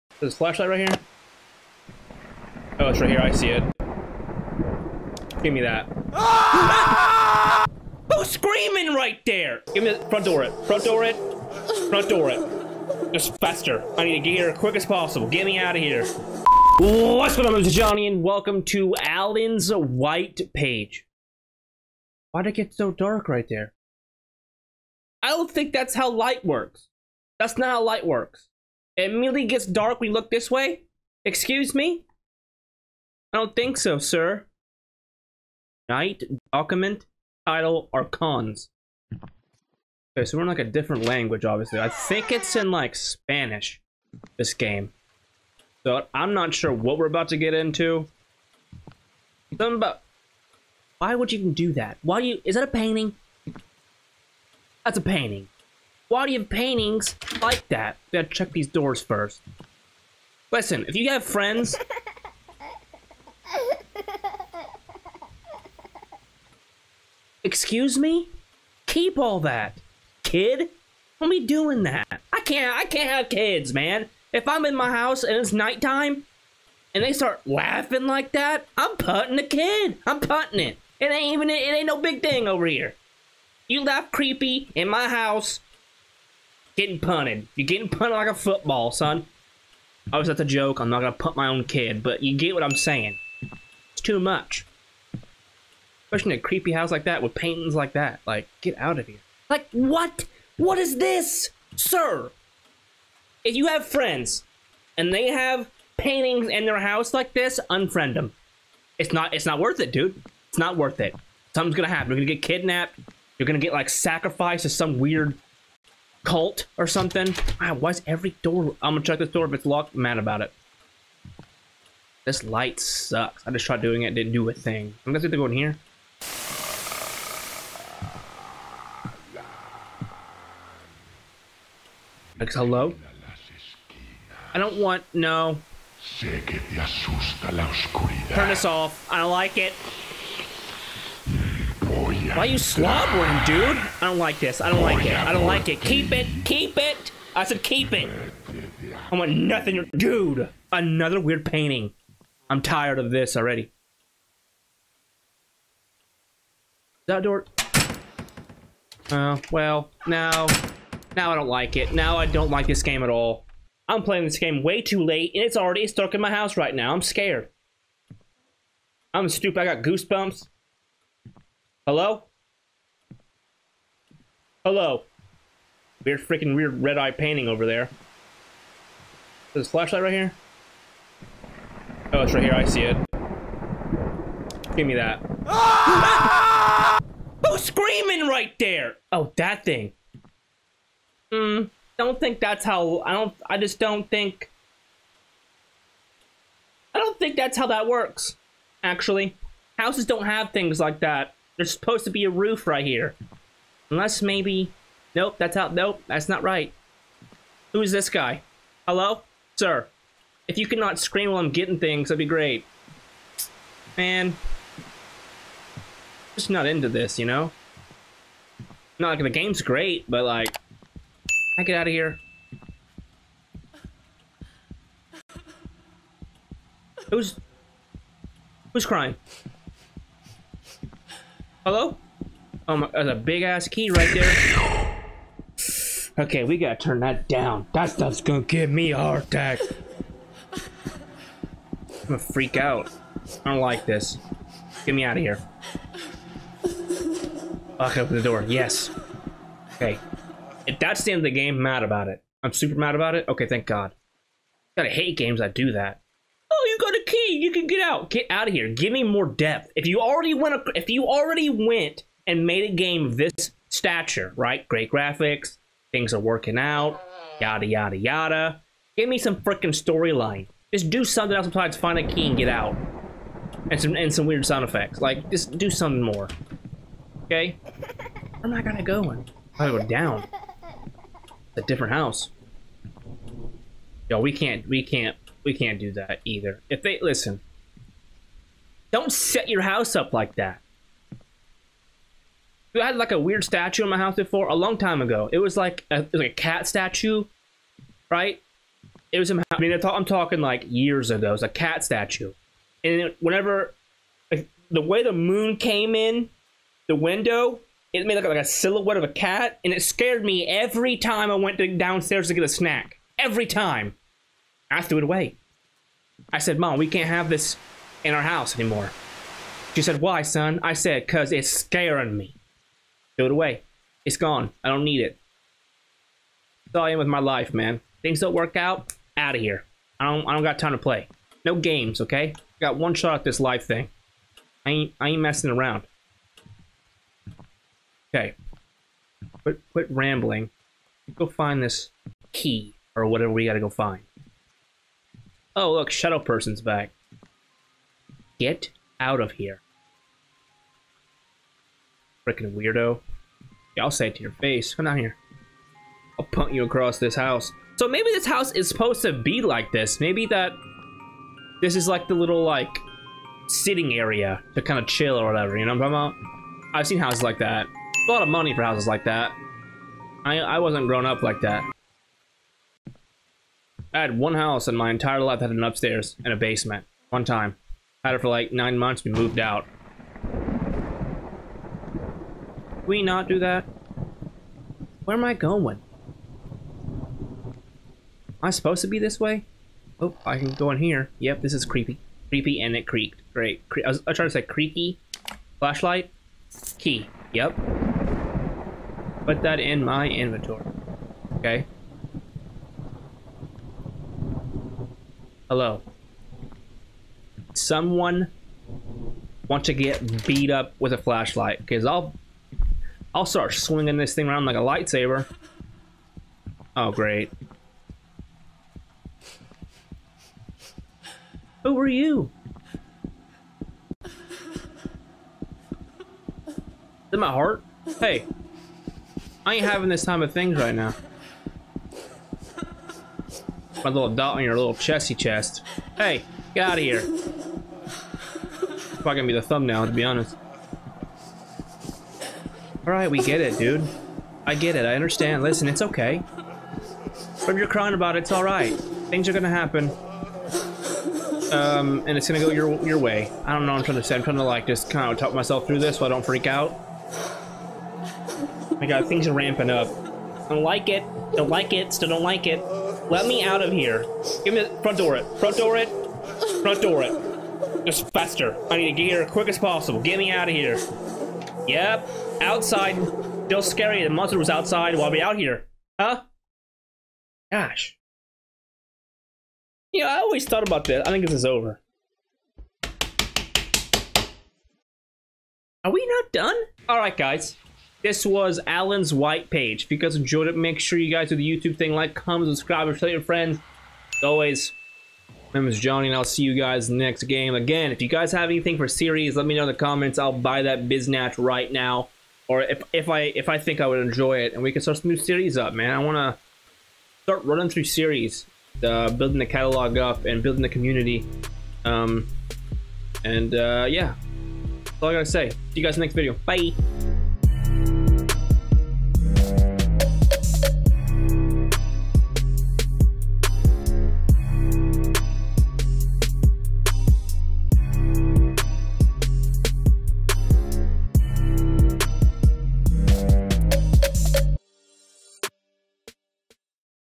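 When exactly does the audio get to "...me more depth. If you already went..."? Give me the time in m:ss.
4:18.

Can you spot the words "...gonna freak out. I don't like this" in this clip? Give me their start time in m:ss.
4:02.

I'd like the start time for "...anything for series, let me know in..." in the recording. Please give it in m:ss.
8:18.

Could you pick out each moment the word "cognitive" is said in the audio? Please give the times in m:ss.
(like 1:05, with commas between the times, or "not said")
not said.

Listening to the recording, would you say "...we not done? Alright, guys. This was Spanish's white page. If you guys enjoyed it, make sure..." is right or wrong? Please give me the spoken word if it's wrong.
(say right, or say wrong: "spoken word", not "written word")
wrong: "Alan", not "Spanish".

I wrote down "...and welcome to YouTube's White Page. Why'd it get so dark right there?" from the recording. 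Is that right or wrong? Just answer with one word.
wrong.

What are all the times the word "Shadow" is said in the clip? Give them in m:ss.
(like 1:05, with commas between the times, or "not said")
5:45.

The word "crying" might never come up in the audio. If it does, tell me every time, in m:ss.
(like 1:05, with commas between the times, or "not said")
3:48, 7:27.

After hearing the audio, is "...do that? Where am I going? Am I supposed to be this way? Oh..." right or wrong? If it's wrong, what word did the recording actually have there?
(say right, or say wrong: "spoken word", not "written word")
right.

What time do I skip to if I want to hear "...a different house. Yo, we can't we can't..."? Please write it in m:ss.
4:41.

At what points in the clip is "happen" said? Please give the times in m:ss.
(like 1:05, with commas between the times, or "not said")
1:51, 7:29.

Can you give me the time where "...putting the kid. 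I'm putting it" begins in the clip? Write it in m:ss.
1:18.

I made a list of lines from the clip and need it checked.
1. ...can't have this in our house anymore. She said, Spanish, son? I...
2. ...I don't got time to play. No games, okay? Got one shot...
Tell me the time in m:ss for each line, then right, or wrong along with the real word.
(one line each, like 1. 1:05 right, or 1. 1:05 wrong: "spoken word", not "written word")
1. 5:16 wrong: "Why", not "Spanish"
2. 5:30 right.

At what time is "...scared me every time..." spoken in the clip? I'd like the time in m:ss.
5:09.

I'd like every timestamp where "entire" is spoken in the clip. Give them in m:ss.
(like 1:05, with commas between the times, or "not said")
6:14.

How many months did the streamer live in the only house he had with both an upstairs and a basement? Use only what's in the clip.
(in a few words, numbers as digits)
9.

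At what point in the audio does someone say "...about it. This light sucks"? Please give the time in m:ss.
2:00.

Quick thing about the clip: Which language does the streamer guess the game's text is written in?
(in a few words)
Spanish.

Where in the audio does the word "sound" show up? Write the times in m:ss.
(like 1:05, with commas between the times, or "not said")
4:34.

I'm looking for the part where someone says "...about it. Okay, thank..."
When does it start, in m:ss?
4:12.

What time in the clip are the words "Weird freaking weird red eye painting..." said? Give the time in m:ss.
2:56.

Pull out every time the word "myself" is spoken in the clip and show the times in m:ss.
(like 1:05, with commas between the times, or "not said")
7:35.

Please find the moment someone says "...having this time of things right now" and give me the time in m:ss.
7:09.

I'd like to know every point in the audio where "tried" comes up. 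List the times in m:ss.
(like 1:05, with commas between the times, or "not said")
2:03, 6:34.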